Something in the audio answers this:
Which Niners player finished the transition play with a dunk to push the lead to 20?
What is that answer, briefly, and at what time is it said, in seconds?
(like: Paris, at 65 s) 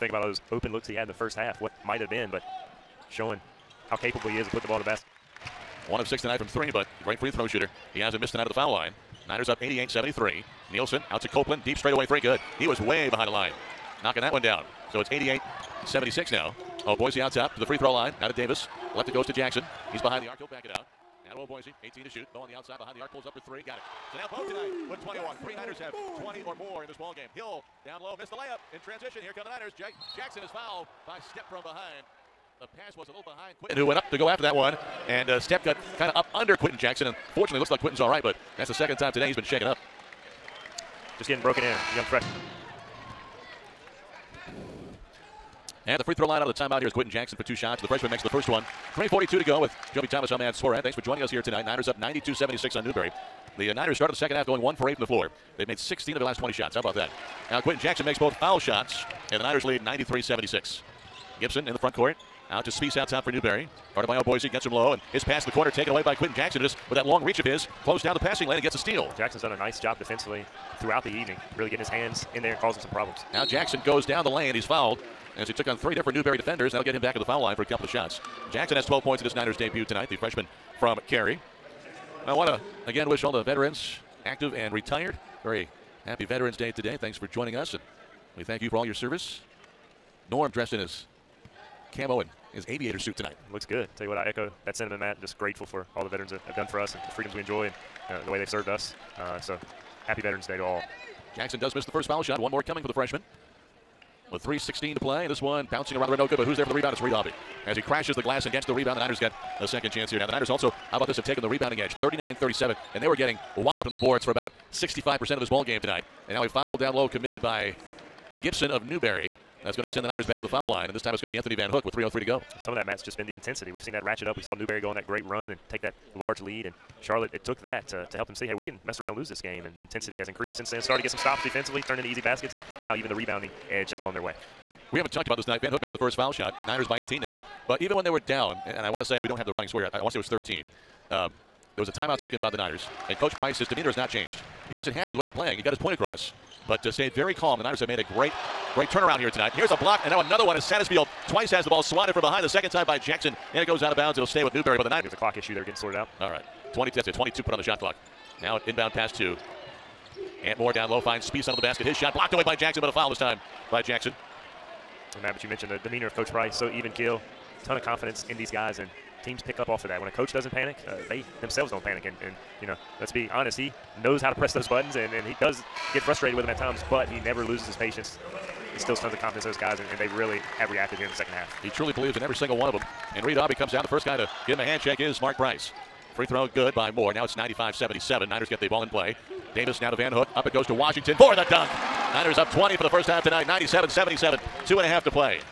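Washington, at 190 s.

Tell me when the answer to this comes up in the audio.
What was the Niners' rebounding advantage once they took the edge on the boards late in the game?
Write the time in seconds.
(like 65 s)
112 s.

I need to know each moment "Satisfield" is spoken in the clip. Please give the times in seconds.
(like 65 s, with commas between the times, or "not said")
150 s.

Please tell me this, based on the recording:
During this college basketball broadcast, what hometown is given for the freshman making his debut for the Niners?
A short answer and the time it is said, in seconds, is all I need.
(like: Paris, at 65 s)
Cary, at 81 s.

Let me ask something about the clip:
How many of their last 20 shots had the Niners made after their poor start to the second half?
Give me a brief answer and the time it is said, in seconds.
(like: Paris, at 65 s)
16, at 55 s.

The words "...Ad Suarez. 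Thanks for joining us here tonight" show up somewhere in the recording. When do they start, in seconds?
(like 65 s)
50 s.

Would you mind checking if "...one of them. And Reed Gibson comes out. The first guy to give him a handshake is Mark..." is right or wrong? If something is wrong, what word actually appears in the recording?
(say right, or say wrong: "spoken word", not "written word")
wrong: "Aubie", not "Gibson".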